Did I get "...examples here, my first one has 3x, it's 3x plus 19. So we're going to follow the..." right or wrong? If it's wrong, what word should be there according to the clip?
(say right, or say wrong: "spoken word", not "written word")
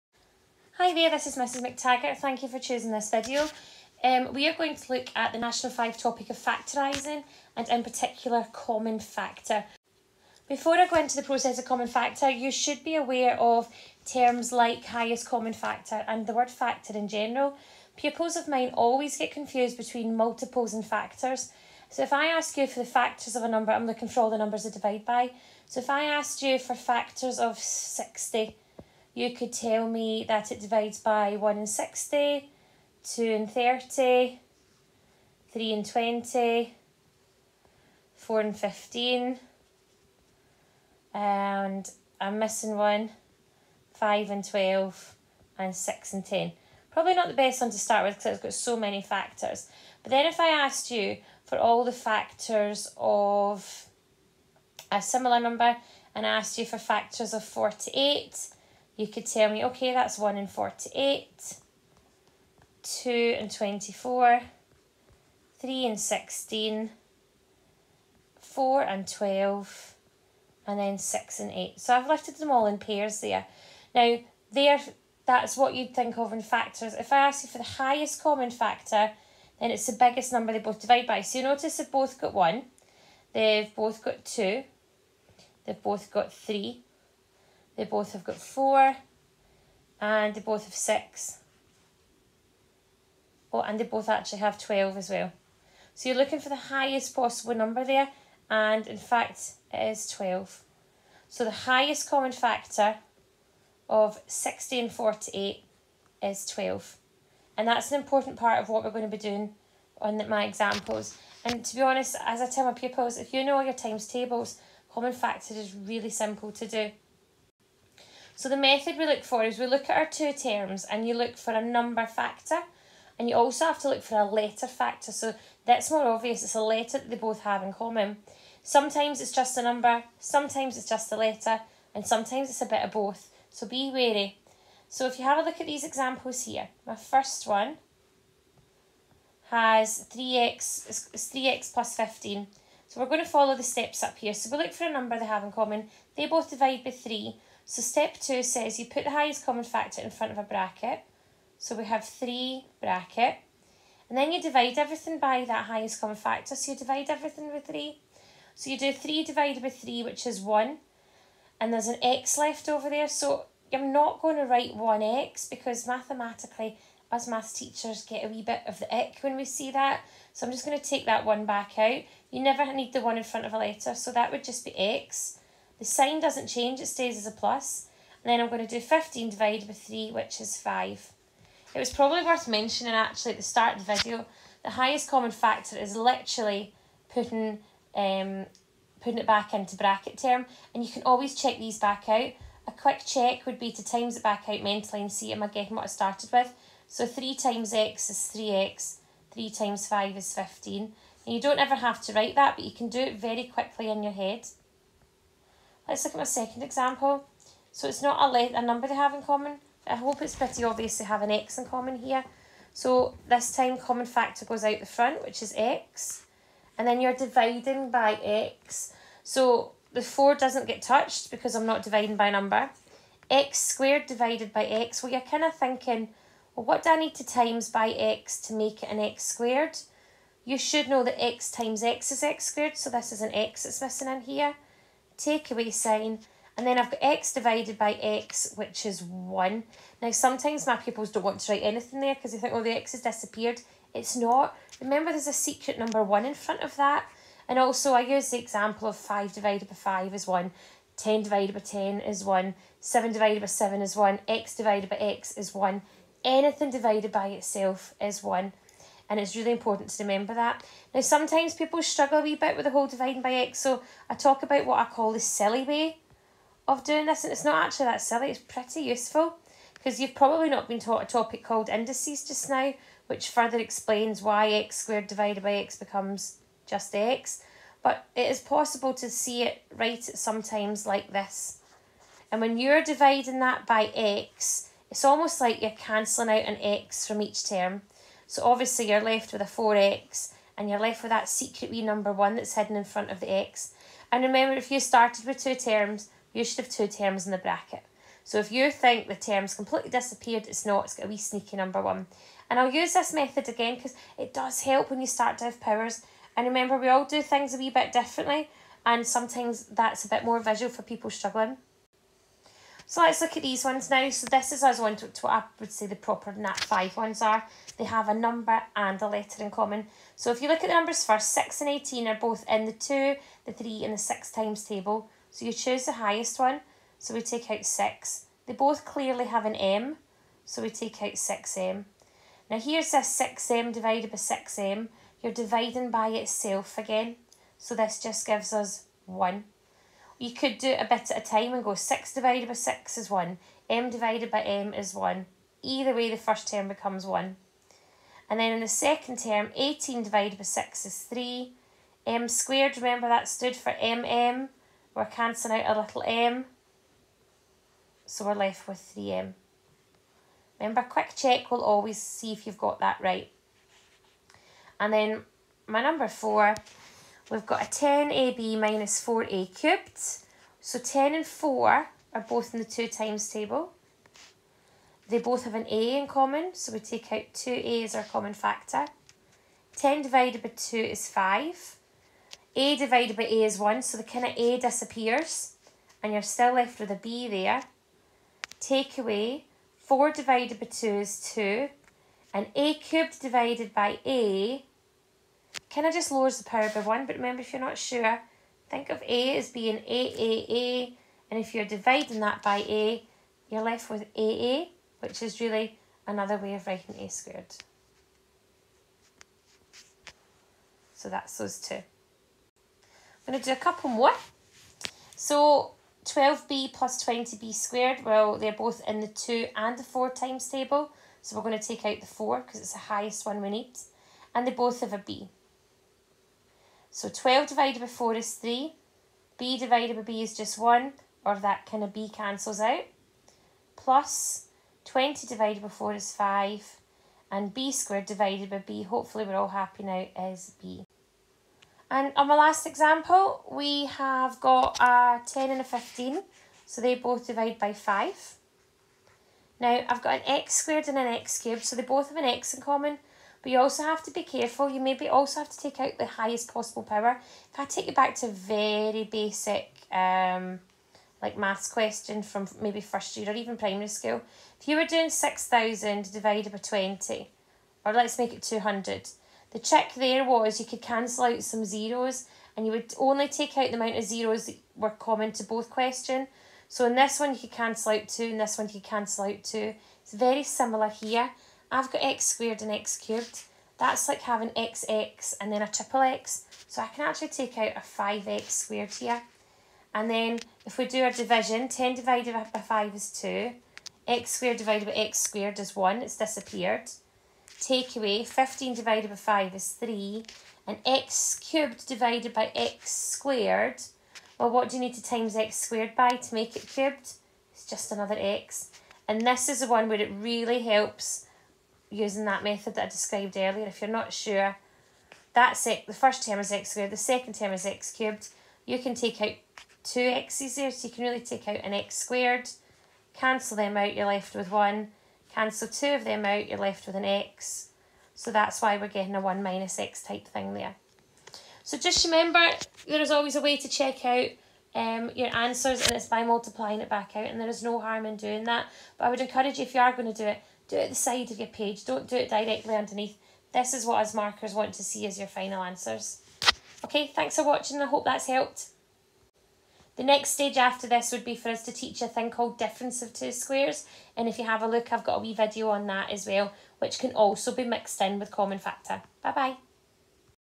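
wrong: "15", not "19".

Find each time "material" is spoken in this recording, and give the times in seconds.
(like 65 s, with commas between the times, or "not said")
not said.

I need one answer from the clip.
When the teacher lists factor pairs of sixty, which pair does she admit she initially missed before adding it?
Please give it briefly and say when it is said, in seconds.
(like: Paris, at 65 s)
5 and 12, at 43 s.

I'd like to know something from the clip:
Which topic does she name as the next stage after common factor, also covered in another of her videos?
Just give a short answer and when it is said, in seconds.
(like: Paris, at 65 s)
difference of two squares, at 552 s.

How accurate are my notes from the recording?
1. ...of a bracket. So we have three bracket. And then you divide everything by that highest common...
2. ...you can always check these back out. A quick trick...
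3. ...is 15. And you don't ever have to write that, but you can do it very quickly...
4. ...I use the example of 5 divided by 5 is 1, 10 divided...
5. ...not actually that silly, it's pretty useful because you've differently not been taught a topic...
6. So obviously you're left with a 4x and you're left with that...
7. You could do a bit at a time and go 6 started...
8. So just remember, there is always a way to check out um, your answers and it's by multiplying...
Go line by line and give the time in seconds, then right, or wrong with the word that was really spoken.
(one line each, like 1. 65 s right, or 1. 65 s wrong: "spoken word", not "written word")
1. 150 s right
2. 190 s wrong: "check", not "trick"
3. 200 s right
4. 247 s right
5. 267 s wrong: "probably", not "differently"
6. 288 s right
7. 340 s wrong: "divided", not "started"
8. 531 s right.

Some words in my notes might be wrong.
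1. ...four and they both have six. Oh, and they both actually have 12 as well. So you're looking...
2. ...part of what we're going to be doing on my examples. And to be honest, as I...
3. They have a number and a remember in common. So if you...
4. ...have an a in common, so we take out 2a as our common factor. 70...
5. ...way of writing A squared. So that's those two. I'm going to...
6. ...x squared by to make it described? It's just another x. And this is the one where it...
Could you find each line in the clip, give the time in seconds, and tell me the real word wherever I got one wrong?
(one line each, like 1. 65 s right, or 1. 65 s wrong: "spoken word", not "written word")
1. 88 s right
2. 108 s right
3. 317 s wrong: "letter", not "remember"
4. 375 s wrong: "10", not "70"
5. 406 s right
6. 505 s wrong: "cubed", not "described".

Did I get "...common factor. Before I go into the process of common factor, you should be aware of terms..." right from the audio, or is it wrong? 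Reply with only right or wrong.
right.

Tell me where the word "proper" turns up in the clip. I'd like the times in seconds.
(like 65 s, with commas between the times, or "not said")
315 s.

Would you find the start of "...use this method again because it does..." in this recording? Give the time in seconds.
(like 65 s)
302 s.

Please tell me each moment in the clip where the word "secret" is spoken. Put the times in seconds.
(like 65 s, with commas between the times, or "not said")
245 s, 291 s.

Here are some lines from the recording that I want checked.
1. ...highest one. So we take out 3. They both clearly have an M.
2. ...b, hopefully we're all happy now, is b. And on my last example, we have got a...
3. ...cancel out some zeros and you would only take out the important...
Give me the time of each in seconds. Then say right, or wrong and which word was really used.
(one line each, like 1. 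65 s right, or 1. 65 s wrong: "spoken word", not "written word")
1. 325 s wrong: "6", not "3"
2. 438 s right
3. 470 s wrong: "amount", not "important".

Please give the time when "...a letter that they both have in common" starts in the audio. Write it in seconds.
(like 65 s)
126 s.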